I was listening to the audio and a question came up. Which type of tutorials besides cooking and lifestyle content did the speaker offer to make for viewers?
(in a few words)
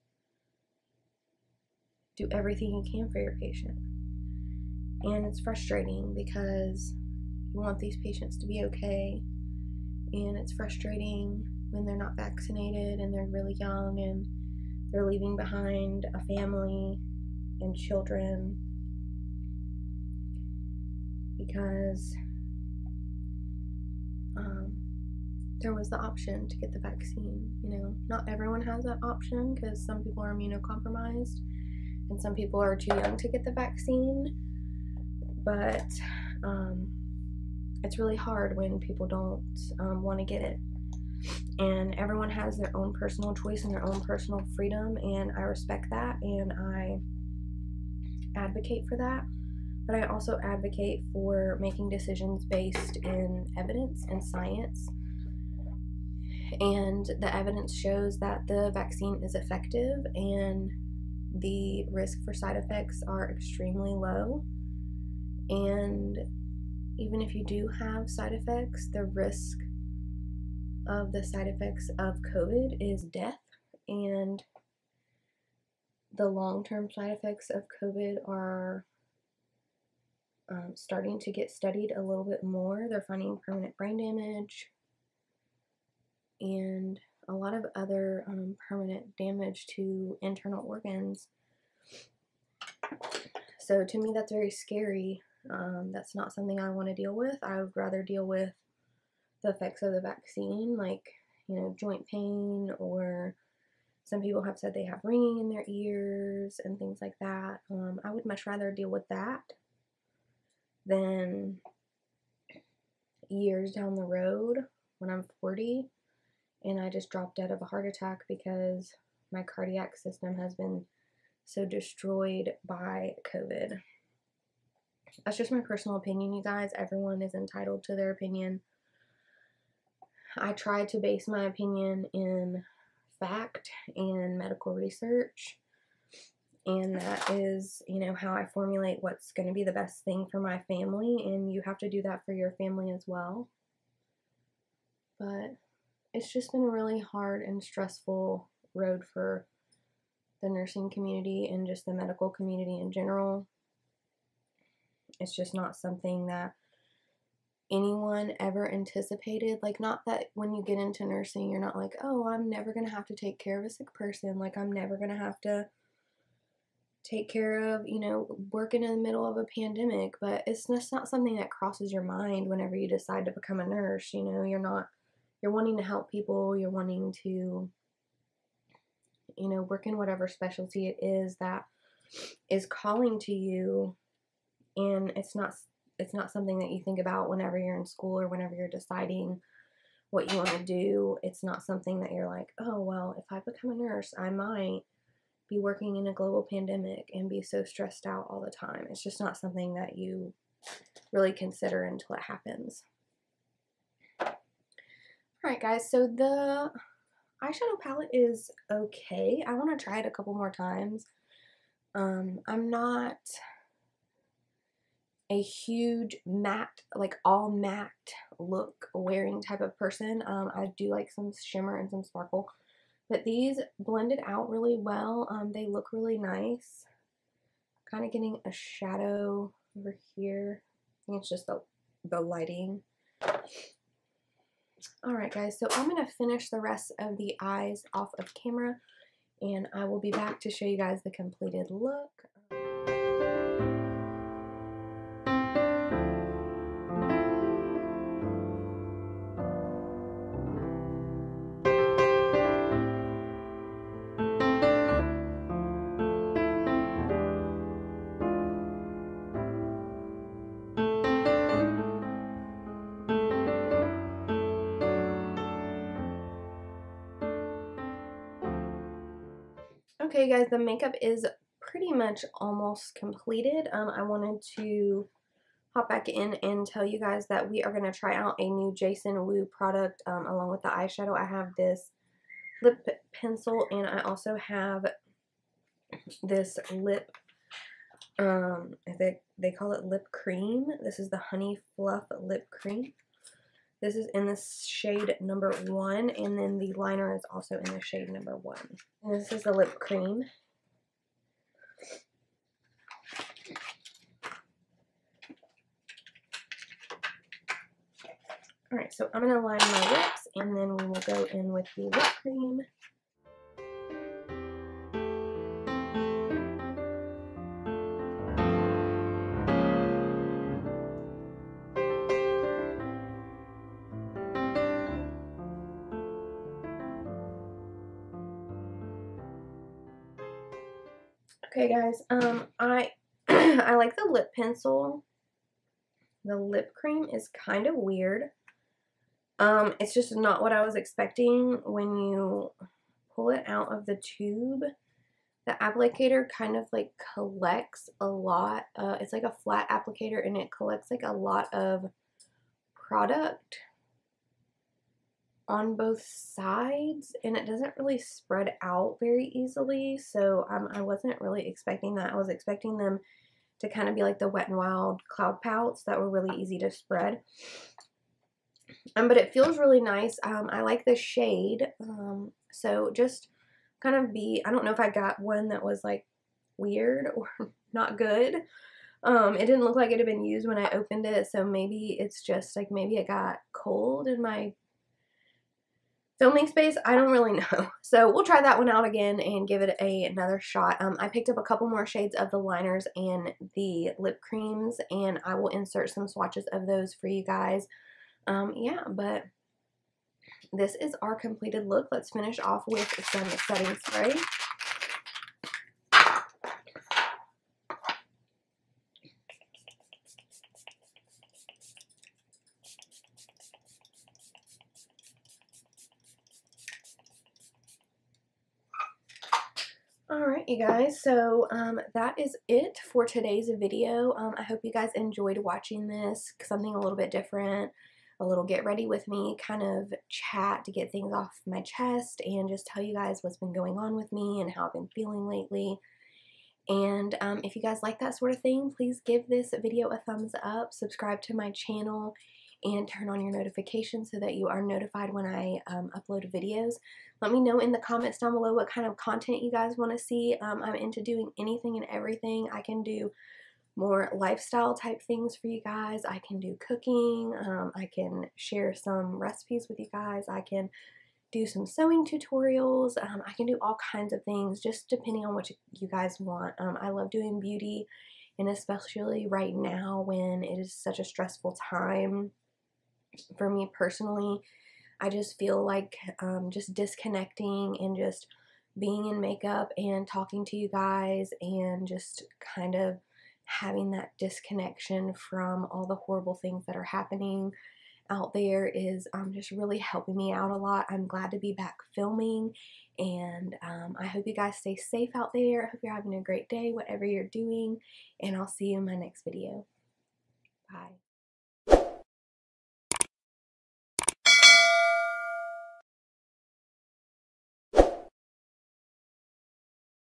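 sewing tutorials.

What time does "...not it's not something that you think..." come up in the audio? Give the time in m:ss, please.
3:05.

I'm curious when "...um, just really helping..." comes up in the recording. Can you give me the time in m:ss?
8:09.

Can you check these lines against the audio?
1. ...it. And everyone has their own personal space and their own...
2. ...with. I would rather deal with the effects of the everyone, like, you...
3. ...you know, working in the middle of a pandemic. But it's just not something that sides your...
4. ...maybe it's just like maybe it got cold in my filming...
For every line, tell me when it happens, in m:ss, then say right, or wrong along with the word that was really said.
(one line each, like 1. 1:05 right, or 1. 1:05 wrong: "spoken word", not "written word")
1. 0:40 wrong: "choice", not "space"
2. 1:37 wrong: "vaccine", not "everyone"
3. 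2:47 wrong: "crosses", not "sides"
4. 6:21 right.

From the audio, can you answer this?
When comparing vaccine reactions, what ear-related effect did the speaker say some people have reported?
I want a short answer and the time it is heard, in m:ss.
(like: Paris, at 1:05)
ringing in their ears, at 1:45.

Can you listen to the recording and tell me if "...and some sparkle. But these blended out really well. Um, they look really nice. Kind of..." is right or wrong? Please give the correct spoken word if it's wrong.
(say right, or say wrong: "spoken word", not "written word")
right.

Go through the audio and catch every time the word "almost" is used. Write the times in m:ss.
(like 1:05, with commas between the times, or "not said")
4:32.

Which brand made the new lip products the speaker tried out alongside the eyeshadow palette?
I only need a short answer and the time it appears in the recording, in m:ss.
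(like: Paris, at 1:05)
Jason Wu, at 4:38.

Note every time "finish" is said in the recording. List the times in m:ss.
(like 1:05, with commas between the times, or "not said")
3:56, 6:42.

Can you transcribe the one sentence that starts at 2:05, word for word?
That's just my personal opinion, you guys.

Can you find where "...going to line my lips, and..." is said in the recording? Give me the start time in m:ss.
5:09.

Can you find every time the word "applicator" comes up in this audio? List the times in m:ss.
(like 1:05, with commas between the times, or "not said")
5:45, 5:49.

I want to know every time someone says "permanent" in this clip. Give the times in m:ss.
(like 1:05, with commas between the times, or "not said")
1:23, 1:28.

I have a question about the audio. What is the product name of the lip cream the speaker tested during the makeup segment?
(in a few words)
Honey Fluff Lip Cream.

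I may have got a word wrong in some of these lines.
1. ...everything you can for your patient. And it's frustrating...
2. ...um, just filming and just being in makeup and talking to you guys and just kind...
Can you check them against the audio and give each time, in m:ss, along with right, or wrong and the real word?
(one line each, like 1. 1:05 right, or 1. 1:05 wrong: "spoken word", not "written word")
1. 0:02 right
2. 7:56 wrong: "disconnecting", not "filming".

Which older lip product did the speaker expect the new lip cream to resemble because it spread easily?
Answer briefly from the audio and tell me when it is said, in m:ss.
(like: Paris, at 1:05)
Wet n Wild cloud pouts, at 6:04.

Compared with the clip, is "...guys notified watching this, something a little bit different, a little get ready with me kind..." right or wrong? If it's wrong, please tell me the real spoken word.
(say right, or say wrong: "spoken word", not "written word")
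wrong: "enjoyed", not "notified".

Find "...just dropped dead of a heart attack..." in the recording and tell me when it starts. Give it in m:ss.
1:56.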